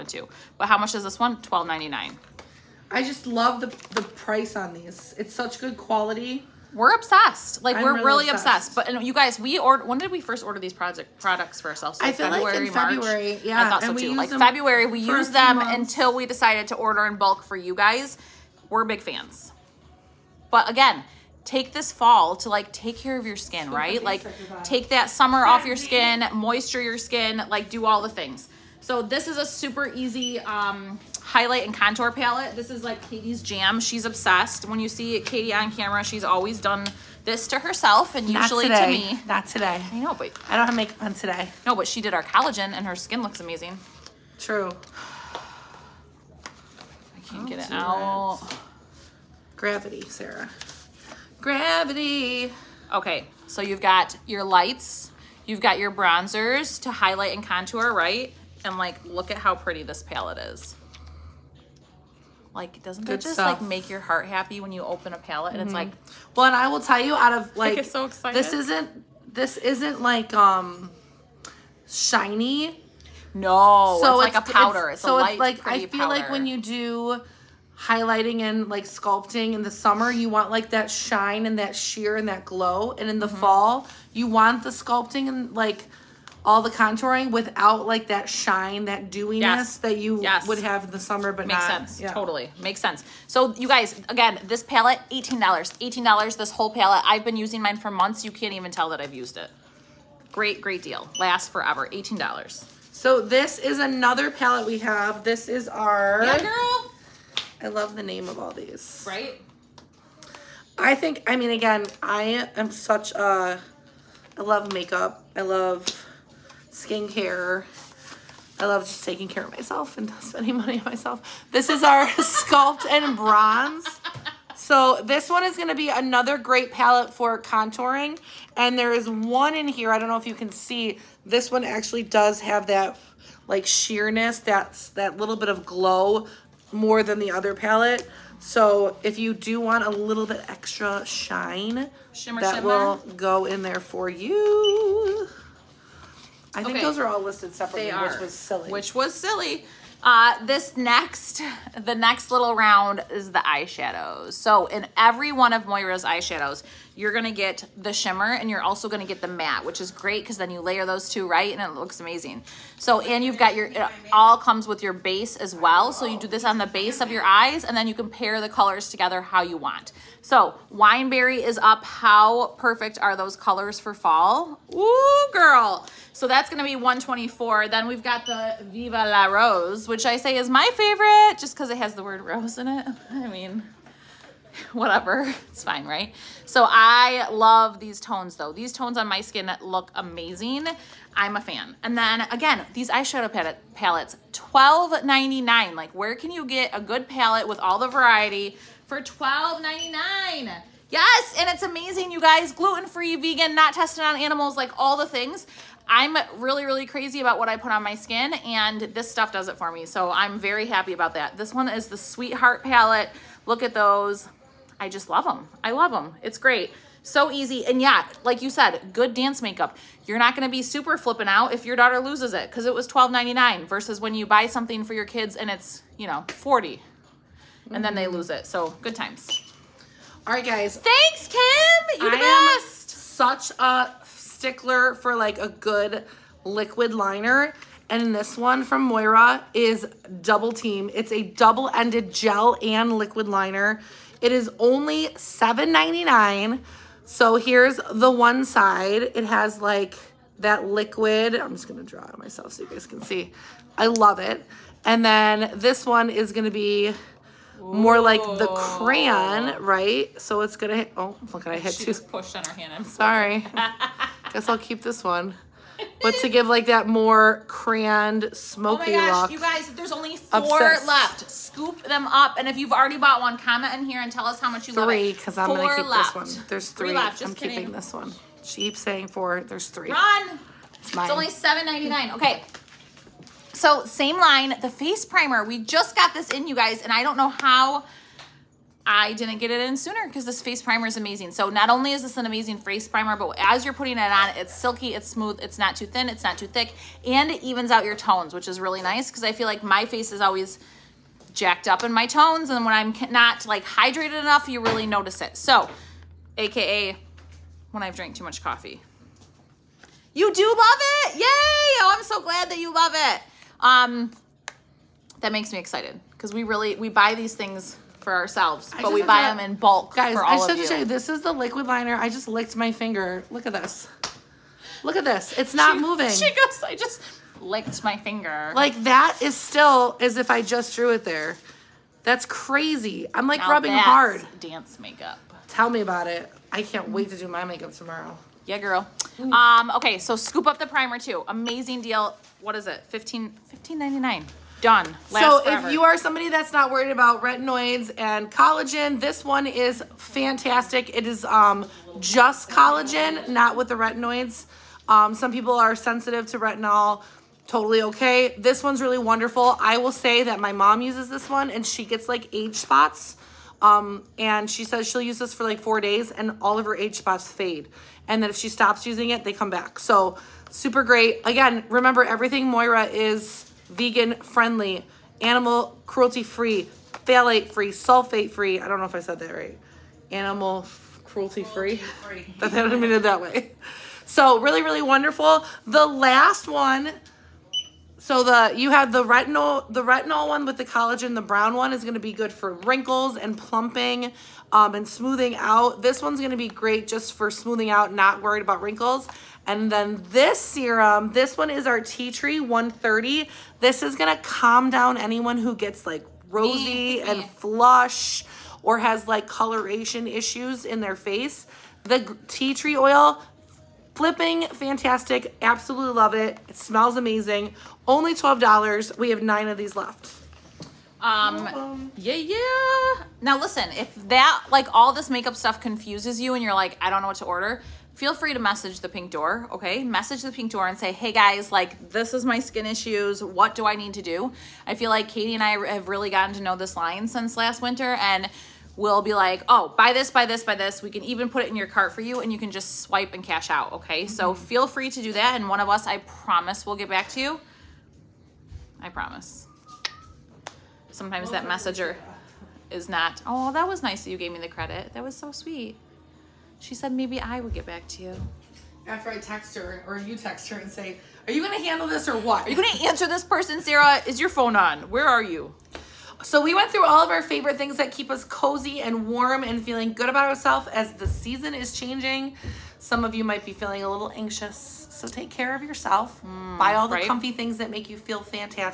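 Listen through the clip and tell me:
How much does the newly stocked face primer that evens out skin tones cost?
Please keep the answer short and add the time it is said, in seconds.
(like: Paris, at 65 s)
$15.99, at 343 s.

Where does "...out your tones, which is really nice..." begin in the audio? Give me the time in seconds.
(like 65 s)
297 s.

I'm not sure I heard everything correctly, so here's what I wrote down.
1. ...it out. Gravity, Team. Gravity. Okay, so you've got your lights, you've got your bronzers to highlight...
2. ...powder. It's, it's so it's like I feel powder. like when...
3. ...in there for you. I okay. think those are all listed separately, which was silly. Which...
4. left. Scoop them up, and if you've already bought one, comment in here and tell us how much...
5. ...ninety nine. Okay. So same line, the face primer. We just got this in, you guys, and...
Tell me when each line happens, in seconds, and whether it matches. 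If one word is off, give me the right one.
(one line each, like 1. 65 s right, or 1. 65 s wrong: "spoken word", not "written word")
1. 47 s wrong: "Sarah", not "Team"
2. 74 s right
3. 143 s right
4. 270 s right
5. 281 s right.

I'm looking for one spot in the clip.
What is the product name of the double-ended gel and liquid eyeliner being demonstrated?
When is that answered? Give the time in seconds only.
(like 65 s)
240 s.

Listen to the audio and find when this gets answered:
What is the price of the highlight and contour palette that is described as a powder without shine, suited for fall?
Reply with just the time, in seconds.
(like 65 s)
94 s.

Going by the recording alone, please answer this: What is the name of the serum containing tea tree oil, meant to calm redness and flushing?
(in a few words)
Tea Tree 130.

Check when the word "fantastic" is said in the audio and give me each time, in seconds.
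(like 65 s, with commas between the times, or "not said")
349 s, 414 s, 478 s.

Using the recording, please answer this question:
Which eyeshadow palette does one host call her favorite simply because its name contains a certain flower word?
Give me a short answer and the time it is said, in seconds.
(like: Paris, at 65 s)
Viva La Rose, at 178 s.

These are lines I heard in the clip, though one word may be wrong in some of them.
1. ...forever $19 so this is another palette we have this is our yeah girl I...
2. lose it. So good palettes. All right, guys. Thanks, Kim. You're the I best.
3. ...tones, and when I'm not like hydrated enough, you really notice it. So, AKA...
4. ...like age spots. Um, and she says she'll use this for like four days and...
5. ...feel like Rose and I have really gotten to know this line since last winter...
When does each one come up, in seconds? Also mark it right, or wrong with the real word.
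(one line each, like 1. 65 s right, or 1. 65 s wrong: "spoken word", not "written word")
1. 101 s wrong: "18", not "19"
2. 228 s wrong: "times", not "palettes"
3. 302 s right
4. 362 s right
5. 434 s wrong: "Katie", not "Rose".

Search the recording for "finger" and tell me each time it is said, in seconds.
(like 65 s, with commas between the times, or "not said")
322 s, 327 s.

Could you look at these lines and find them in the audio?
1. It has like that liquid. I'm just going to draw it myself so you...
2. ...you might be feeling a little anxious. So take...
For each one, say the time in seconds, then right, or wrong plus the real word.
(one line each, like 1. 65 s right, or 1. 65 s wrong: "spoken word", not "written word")
1. 249 s right
2. 473 s right.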